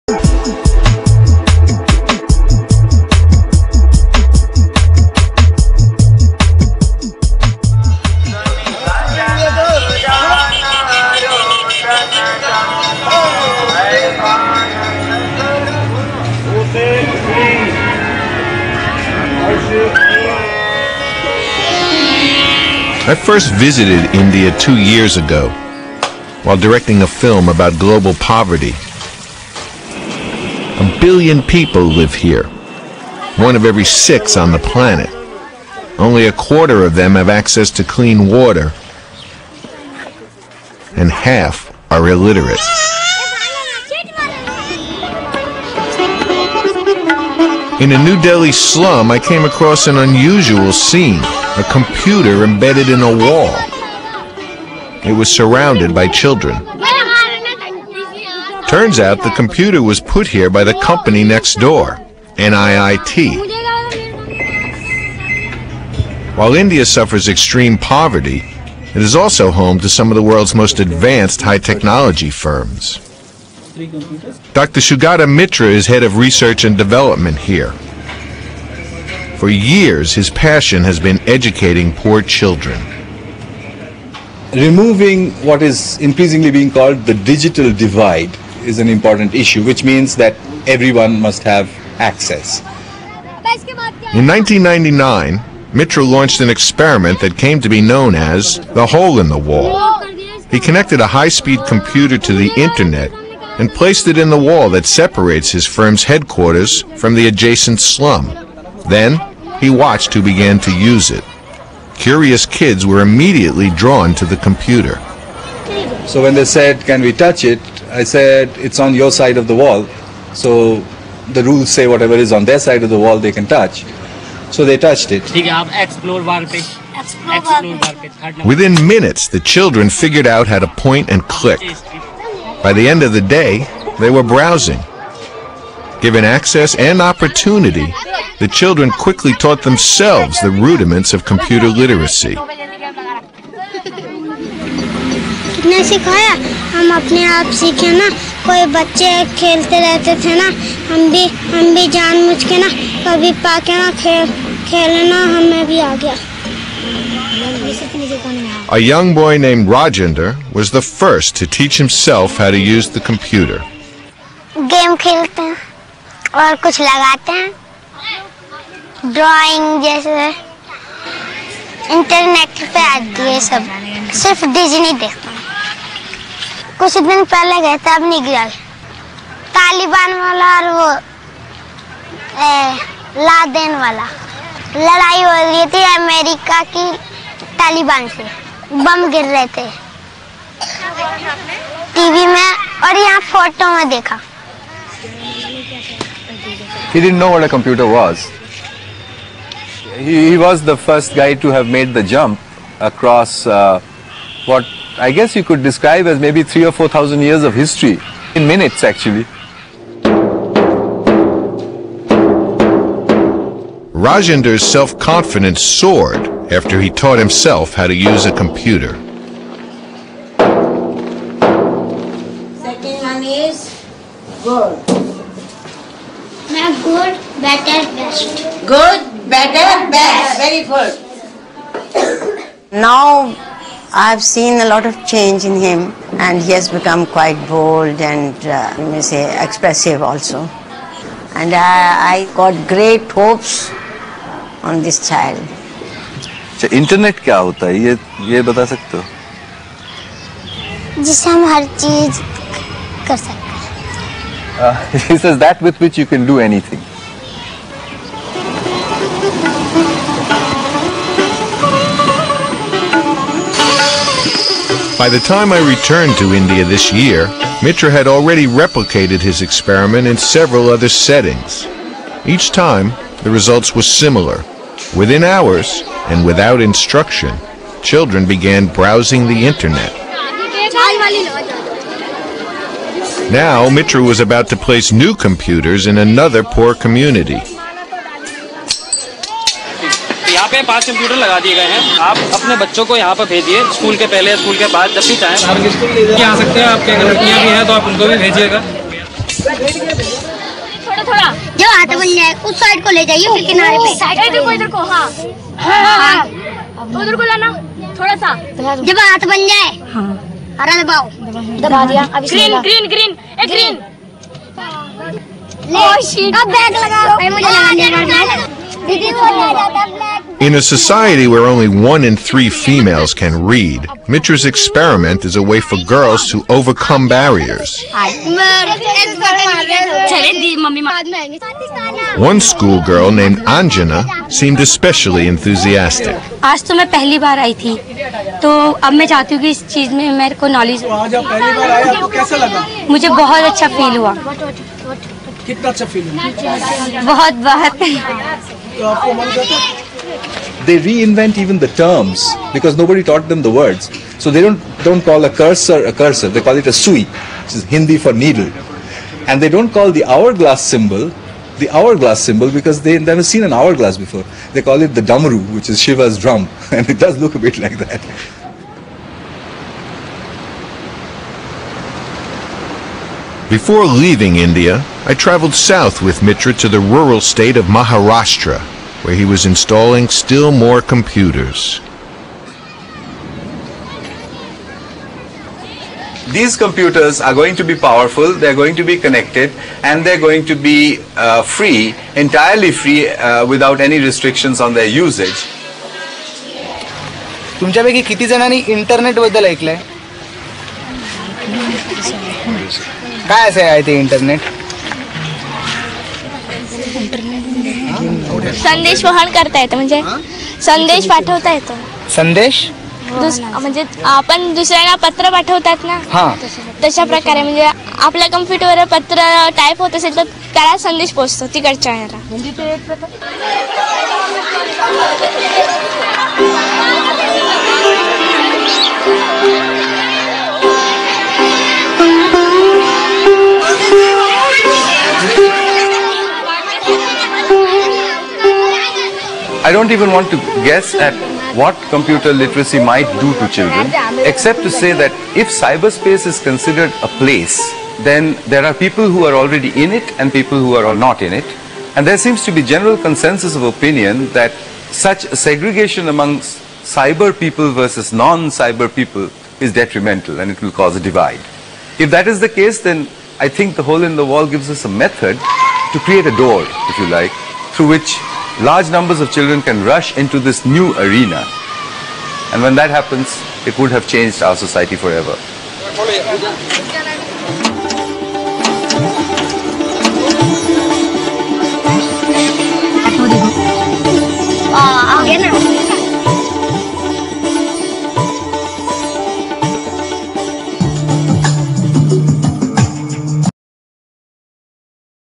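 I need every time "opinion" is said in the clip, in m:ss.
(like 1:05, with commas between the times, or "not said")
7:33.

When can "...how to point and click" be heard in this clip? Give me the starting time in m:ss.
2:10.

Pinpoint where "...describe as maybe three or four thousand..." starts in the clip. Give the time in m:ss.
3:25.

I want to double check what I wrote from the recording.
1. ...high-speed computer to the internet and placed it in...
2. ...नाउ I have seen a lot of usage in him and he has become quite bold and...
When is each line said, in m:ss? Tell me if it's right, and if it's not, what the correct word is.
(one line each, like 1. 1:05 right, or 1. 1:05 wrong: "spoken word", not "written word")
1. 1:41 right
2. 3:52 wrong: "change", not "usage".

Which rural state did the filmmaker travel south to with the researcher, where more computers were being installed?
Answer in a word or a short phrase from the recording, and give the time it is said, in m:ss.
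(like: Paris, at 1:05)
Maharashtra, at 6:17.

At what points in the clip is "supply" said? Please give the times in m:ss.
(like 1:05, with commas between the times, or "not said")
not said.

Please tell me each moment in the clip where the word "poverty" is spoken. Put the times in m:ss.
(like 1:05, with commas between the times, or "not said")
0:28, 1:07.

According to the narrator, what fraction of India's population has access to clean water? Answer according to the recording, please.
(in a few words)
a quarter.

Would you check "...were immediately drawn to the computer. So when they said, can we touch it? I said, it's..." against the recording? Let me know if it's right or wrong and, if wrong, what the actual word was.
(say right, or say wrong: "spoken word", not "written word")
right.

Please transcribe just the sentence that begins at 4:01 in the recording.
And I, I got great hopes on this child.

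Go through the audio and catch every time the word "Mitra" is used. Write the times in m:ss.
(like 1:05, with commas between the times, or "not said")
1:15, 1:35, 4:27, 5:24, 6:16.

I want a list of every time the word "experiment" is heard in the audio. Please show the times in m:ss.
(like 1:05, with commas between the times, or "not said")
1:36, 4:29, 5:24.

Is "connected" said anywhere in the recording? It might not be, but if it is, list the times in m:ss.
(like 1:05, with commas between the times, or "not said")
1:40, 6:28.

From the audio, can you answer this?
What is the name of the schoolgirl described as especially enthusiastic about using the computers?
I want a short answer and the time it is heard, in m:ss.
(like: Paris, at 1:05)
Anjana, at 5:33.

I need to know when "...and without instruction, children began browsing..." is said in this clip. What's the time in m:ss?
4:36.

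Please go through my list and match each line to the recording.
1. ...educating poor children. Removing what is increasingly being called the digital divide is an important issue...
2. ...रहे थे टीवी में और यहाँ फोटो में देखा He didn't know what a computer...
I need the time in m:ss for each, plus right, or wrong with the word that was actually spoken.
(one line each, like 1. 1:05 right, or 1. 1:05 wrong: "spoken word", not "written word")
1. 1:21 right
2. 3:09 right.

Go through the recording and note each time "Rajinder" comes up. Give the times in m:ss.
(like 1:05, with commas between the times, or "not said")
2:39, 3:34.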